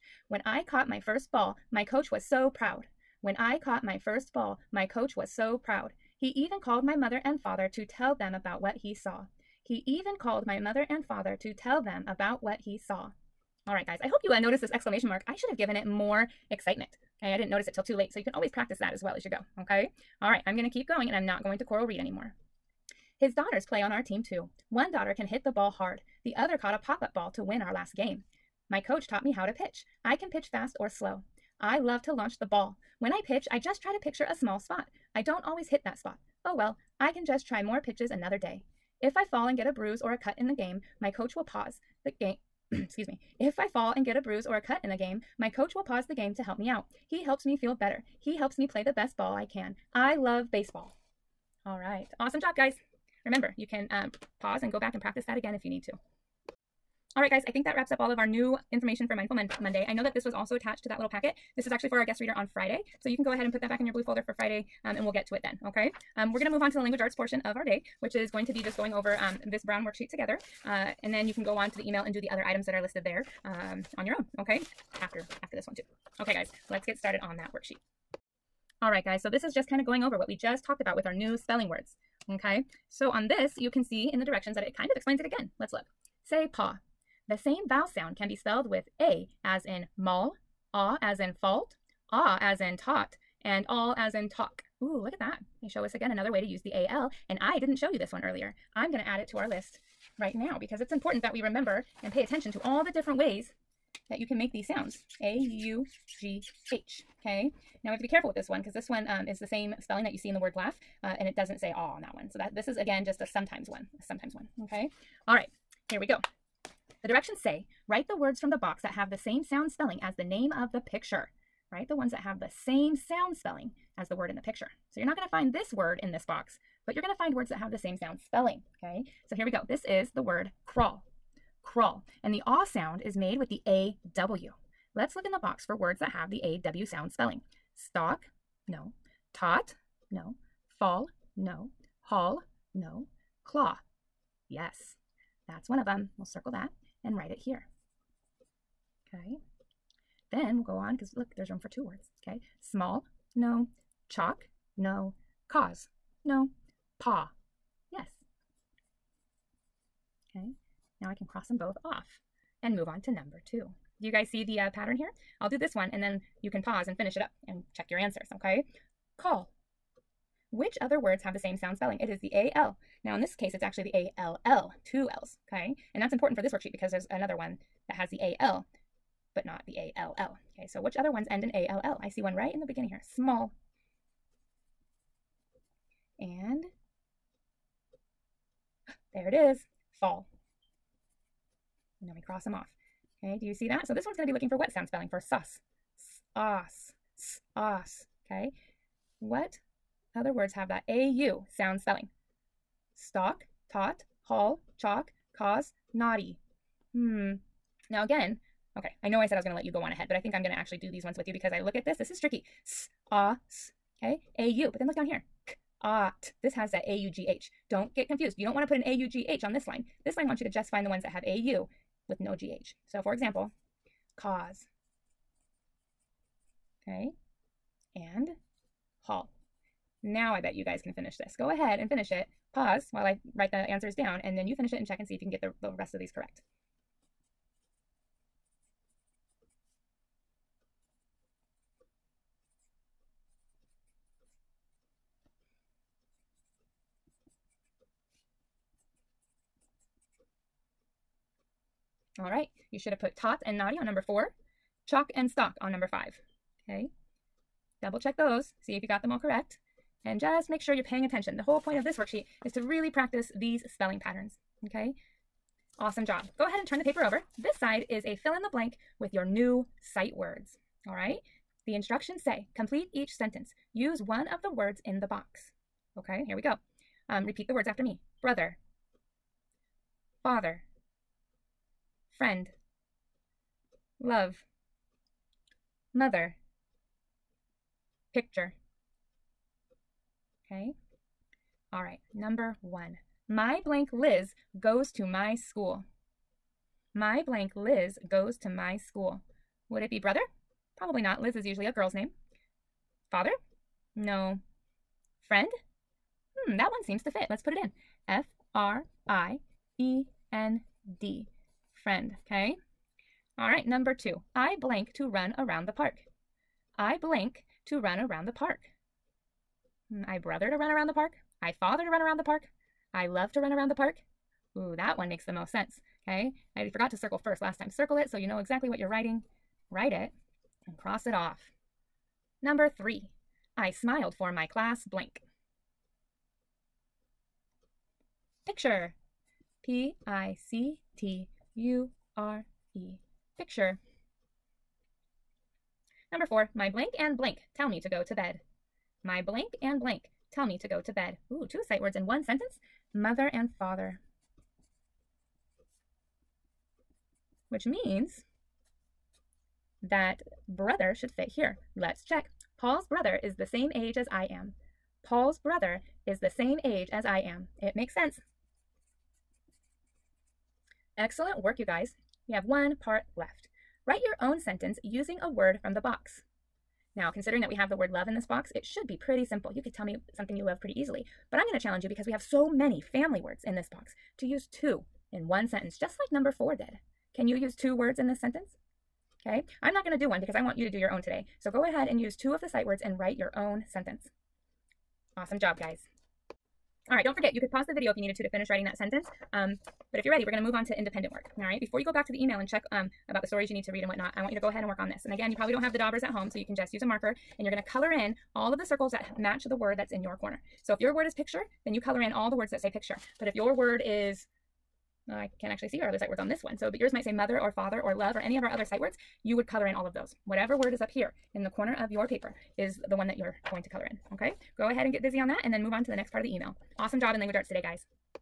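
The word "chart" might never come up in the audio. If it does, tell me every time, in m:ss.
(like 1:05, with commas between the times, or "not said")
not said.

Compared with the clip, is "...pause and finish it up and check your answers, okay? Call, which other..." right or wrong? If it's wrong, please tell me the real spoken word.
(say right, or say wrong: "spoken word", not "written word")
right.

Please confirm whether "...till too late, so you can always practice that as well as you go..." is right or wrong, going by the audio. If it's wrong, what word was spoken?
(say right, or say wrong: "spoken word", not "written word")
right.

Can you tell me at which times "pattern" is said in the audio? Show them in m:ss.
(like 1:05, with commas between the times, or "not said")
2:44, 4:23.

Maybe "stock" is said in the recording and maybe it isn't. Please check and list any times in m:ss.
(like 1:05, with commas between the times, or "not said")
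2:17, 3:22, 4:15.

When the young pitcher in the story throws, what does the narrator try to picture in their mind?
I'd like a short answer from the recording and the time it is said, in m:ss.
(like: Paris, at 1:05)
a small spot, at 0:34.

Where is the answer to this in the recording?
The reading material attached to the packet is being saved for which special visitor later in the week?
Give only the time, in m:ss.
1:02.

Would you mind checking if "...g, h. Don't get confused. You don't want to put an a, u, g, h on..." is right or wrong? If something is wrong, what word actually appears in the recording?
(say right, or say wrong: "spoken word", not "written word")
right.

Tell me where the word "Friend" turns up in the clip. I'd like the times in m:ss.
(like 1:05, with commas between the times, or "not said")
4:42, 5:05, 5:11.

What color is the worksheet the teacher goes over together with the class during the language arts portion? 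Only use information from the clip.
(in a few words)
Brown.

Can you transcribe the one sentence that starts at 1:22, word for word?
So on this, you can see in the directions that it kind of explains it again.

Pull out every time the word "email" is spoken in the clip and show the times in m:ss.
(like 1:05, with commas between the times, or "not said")
1:11, 6:42, 7:06.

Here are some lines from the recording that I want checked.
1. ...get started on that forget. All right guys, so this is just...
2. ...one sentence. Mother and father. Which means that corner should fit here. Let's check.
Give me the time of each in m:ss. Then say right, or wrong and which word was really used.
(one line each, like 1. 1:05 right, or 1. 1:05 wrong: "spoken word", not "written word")
1. 1:16 wrong: "worksheet", not "forget"
2. 5:52 wrong: "brother", not "corner".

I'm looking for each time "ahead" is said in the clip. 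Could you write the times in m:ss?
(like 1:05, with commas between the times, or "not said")
1:03, 3:29, 3:51, 4:26, 6:31, 6:44, 7:04.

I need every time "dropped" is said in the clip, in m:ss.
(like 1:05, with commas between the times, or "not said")
not said.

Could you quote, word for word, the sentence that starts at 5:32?
Number three, I smiled for my class blank.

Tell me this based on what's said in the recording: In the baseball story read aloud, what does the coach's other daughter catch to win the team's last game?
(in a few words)
pop-up ball.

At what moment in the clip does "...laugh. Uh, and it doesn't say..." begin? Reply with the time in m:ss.
1:50.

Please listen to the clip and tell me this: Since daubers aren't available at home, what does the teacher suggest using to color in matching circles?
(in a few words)
a marker.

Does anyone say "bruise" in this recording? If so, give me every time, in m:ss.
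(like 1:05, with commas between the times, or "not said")
0:39, 0:44.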